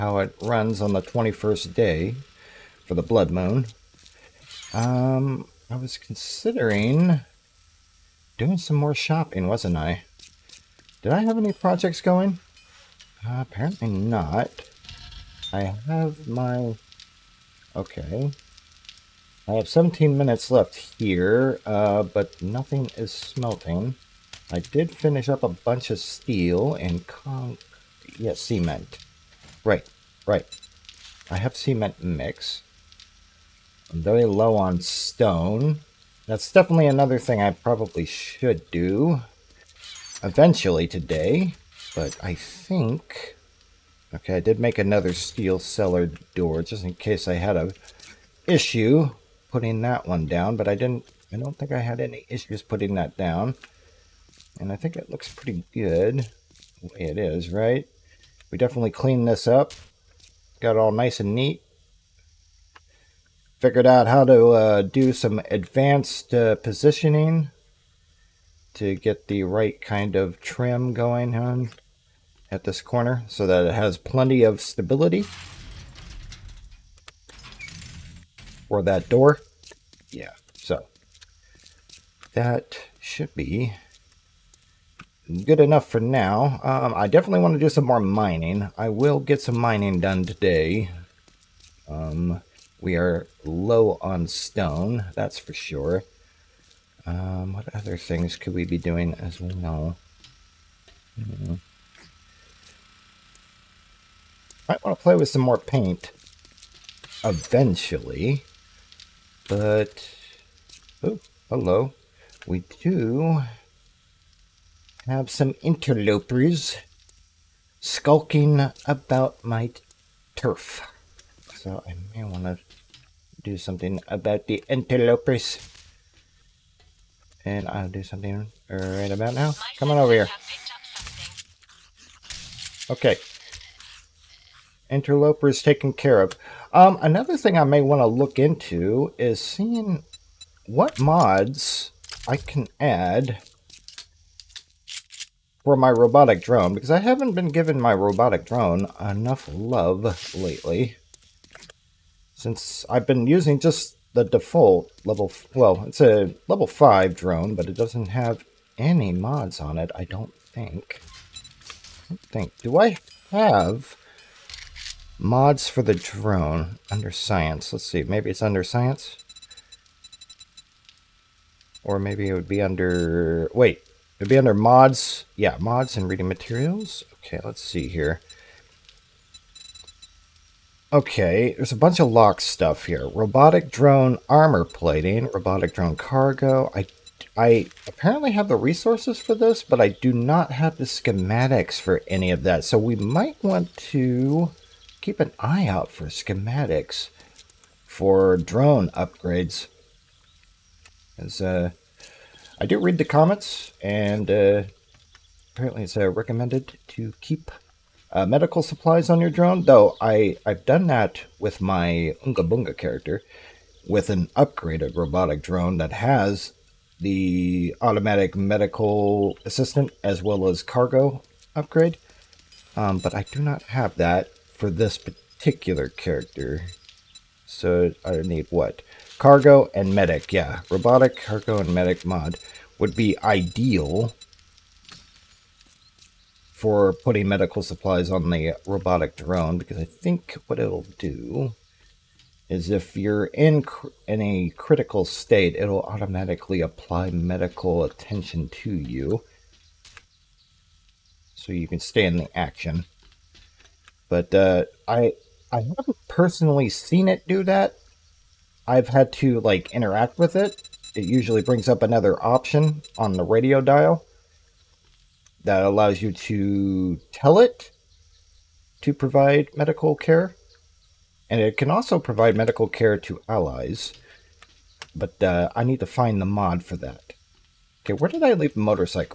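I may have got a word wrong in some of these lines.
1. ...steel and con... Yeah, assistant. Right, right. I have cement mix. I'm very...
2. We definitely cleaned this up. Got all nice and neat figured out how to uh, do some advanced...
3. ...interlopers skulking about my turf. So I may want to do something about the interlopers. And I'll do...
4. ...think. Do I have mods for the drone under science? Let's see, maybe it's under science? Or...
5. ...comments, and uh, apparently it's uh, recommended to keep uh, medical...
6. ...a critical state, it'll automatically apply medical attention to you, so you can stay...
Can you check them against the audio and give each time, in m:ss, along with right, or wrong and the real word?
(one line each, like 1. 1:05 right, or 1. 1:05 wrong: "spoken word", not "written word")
1. 0:25 wrong: "cement", not "assistant"
2. 0:58 right
3. 1:55 right
4. 2:42 right
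5. 3:23 right
6. 4:04 right.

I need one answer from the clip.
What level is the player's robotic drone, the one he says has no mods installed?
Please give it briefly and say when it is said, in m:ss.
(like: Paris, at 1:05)
5, at 2:36.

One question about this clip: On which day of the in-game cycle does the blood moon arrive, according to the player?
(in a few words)
21st.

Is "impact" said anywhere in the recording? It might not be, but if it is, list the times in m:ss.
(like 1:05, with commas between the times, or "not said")
not said.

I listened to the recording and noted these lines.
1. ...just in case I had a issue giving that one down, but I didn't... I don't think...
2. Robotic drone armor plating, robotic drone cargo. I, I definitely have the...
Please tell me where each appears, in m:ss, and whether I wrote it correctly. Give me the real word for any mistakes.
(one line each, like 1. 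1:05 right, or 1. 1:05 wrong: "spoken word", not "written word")
1. 0:46 wrong: "putting", not "giving"
2. 3:03 wrong: "apparently", not "definitely".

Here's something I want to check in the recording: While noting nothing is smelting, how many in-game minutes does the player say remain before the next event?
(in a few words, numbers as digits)
17.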